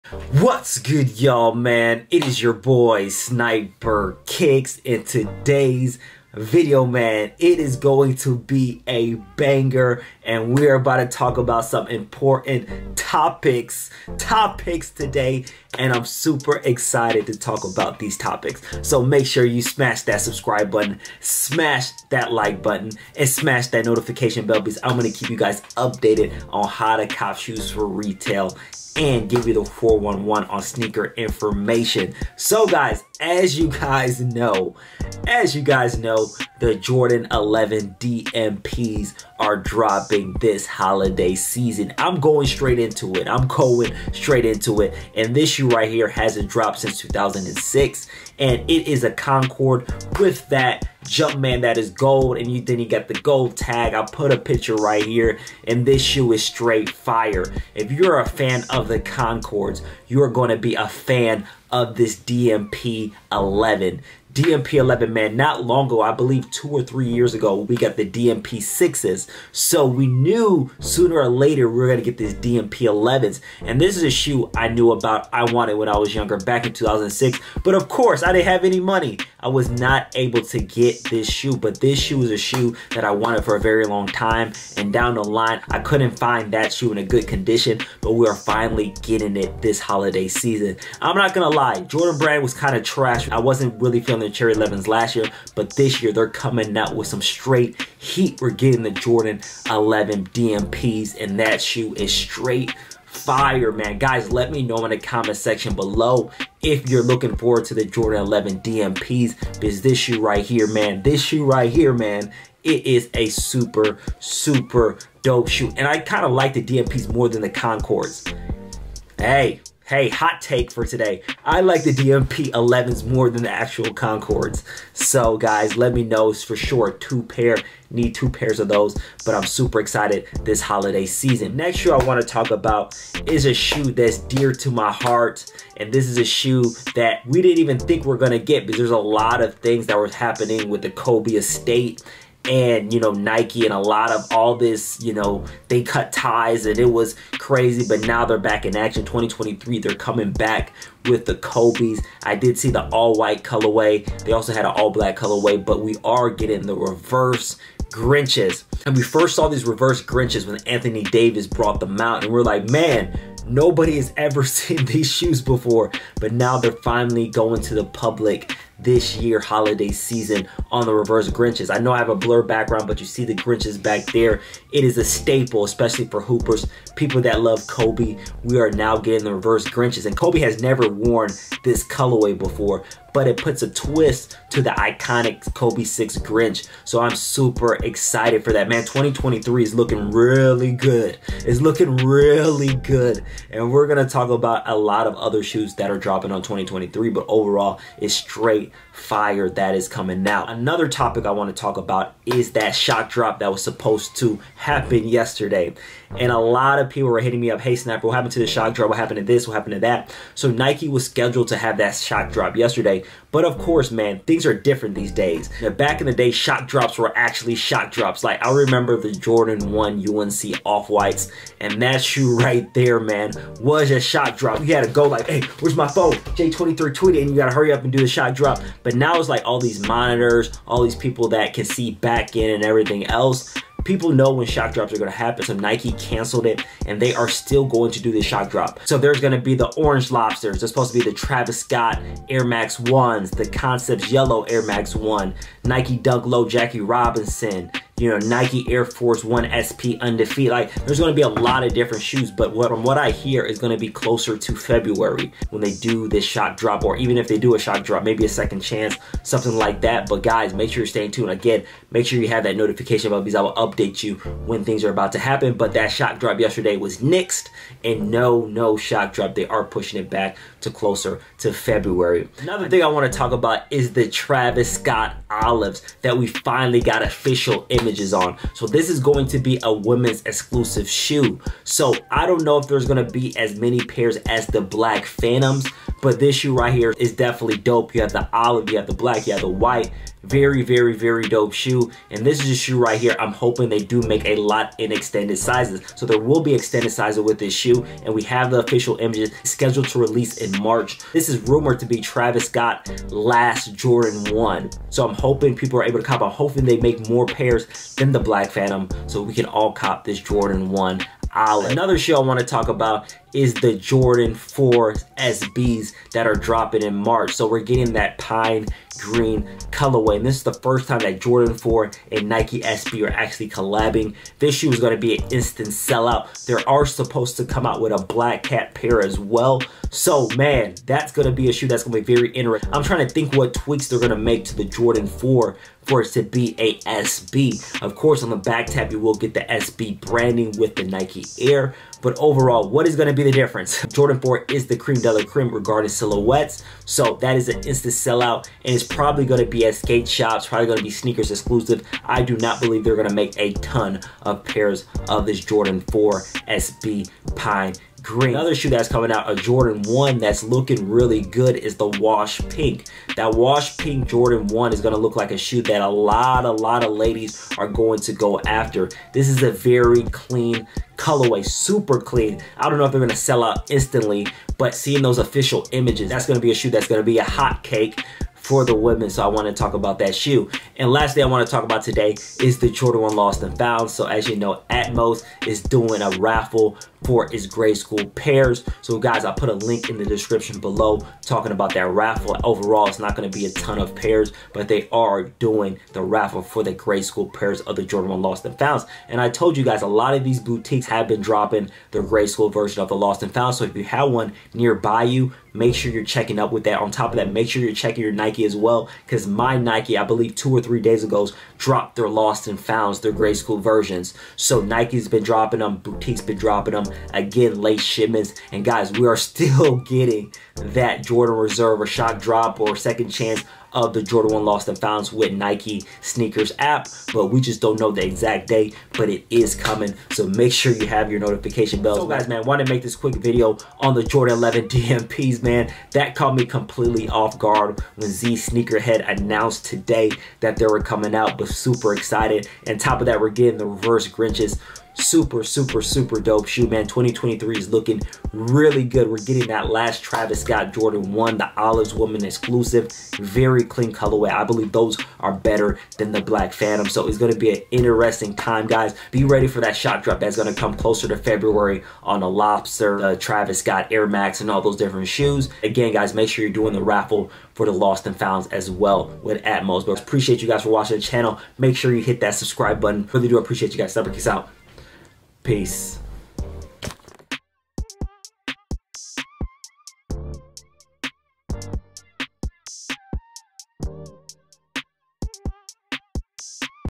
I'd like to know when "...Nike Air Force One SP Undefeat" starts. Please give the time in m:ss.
4:08.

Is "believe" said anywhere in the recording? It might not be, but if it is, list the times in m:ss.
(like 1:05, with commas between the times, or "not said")
1:06, 5:52, 6:50, 7:34.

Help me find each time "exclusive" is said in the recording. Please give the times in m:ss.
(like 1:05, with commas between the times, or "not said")
4:40, 5:51, 7:32.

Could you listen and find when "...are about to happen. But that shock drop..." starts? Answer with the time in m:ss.
4:24.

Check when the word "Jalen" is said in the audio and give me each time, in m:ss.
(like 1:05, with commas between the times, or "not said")
not said.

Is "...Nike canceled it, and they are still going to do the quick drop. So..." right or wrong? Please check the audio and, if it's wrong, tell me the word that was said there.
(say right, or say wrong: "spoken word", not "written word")
wrong: "shock", not "quick".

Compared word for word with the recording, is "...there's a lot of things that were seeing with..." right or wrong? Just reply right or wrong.
wrong.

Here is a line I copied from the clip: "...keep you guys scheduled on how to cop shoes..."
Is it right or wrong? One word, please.
wrong.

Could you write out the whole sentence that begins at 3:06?
So I'm super excited for that.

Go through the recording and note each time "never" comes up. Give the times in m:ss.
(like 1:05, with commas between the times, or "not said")
3:00, 7:53.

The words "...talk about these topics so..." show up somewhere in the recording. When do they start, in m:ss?
0:17.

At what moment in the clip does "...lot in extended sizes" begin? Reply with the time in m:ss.
4:54.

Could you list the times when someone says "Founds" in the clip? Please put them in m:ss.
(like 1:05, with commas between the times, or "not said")
6:23, 6:38, 6:43, 6:52, 7:04, 7:48.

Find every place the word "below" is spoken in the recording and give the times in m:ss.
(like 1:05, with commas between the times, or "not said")
1:45, 6:30.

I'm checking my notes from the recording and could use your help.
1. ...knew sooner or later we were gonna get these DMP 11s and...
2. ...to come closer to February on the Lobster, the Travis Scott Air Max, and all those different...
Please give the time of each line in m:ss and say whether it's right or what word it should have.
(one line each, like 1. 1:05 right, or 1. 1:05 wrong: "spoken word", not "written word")
1. 1:10 right
2. 7:40 right.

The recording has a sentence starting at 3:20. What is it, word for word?
Another topic I want to talk about is that shock drop that was supposed to happen yesterday.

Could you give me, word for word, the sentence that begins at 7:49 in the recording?
But appreciate you guys for watching the channel.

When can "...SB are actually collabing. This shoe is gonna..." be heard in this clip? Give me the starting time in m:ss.
5:22.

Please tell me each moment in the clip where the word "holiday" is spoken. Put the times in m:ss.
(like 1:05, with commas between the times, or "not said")
0:40, 1:29, 2:10, 2:49.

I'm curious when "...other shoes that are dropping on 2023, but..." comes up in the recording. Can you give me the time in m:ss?
3:15.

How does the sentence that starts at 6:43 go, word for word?
So if you have one nearby you, make sure you're checking up with that.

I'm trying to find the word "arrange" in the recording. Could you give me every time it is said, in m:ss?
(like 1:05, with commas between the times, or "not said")
not said.